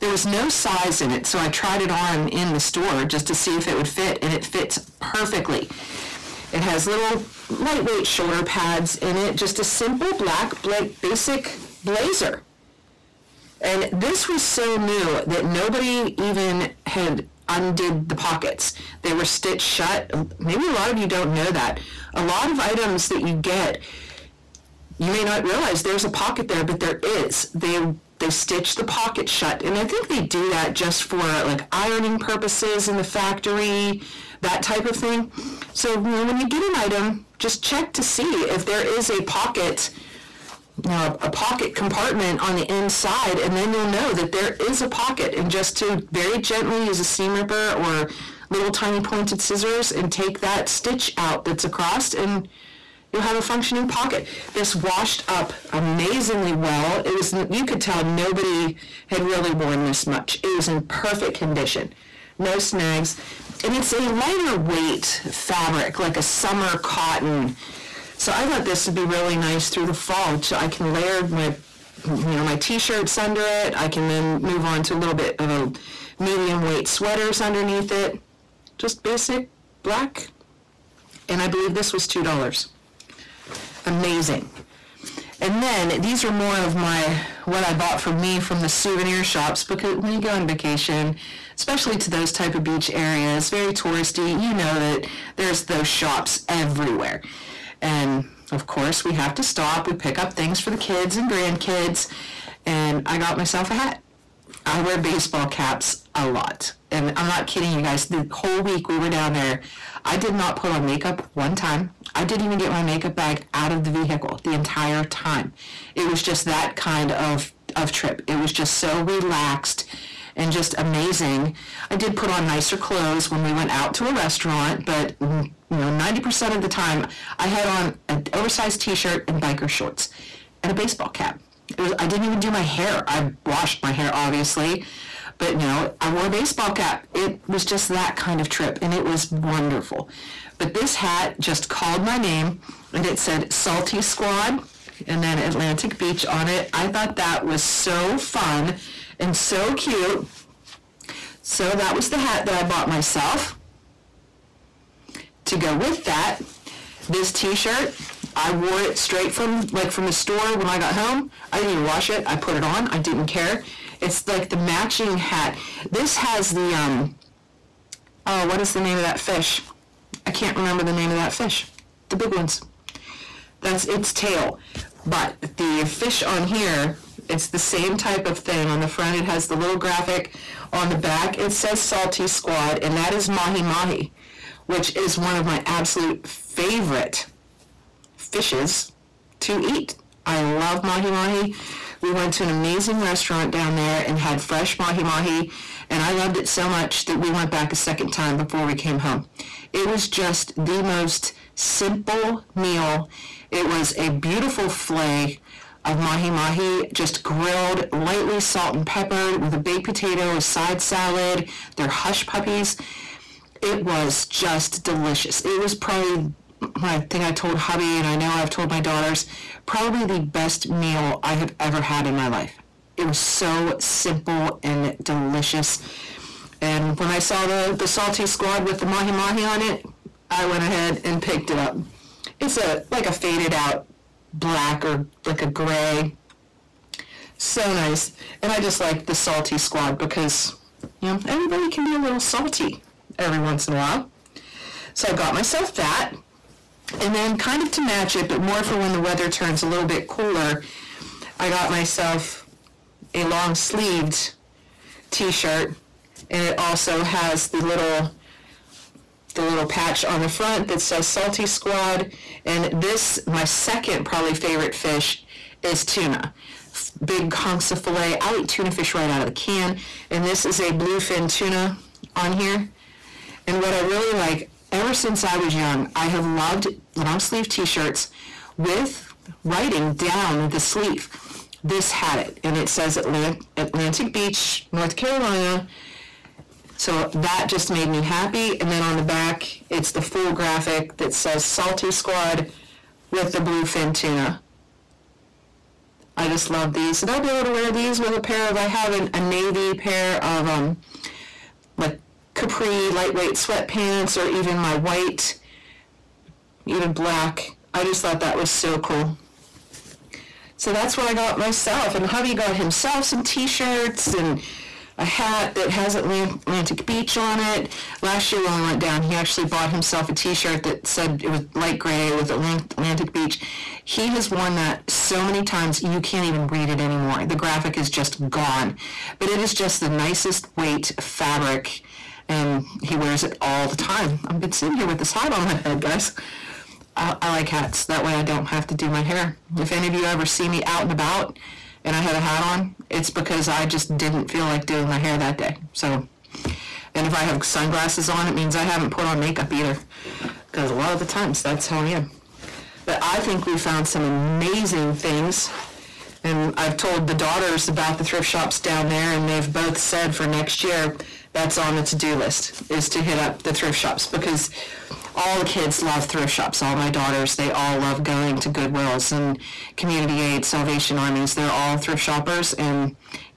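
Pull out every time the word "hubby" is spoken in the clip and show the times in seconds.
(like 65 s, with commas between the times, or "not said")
217 s, 312 s.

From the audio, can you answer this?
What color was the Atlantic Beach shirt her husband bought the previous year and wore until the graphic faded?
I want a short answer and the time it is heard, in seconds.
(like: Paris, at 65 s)
light gray, at 321 s.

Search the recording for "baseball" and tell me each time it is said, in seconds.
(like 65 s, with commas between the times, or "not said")
104 s, 130 s, 136 s.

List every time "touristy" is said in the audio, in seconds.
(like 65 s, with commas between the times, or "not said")
93 s.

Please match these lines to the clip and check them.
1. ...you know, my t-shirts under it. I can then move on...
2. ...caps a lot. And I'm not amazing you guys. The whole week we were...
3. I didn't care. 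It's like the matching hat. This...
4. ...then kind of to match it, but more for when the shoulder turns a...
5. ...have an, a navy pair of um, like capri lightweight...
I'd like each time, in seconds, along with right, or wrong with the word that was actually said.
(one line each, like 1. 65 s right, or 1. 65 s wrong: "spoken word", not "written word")
1. 72 s right
2. 105 s wrong: "kidding", not "amazing"
3. 162 s right
4. 247 s wrong: "weather", not "shoulder"
5. 298 s right.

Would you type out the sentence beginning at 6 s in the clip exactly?
It has little lightweight shoulder pads in it, just a simple black basic blazer.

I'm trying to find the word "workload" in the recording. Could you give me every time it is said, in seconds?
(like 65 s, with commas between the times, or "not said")
not said.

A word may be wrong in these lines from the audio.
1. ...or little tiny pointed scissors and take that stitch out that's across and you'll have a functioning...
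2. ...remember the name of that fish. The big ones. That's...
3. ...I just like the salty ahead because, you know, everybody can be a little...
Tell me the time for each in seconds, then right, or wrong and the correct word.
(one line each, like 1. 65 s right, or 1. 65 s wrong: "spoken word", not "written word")
1. 47 s right
2. 170 s right
3. 238 s wrong: "squad", not "ahead".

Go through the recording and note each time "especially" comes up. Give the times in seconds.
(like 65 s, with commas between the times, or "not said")
91 s.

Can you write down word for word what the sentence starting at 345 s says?
So, and if I have sunglasses on, it means I haven't put on makeup either.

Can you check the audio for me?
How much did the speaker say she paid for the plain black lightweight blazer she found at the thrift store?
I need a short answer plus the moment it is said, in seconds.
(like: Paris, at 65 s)
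$2, at 82 s.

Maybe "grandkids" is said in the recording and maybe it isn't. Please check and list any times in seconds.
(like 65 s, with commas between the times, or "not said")
101 s.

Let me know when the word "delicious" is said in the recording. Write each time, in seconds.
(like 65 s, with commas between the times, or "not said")
214 s, 225 s.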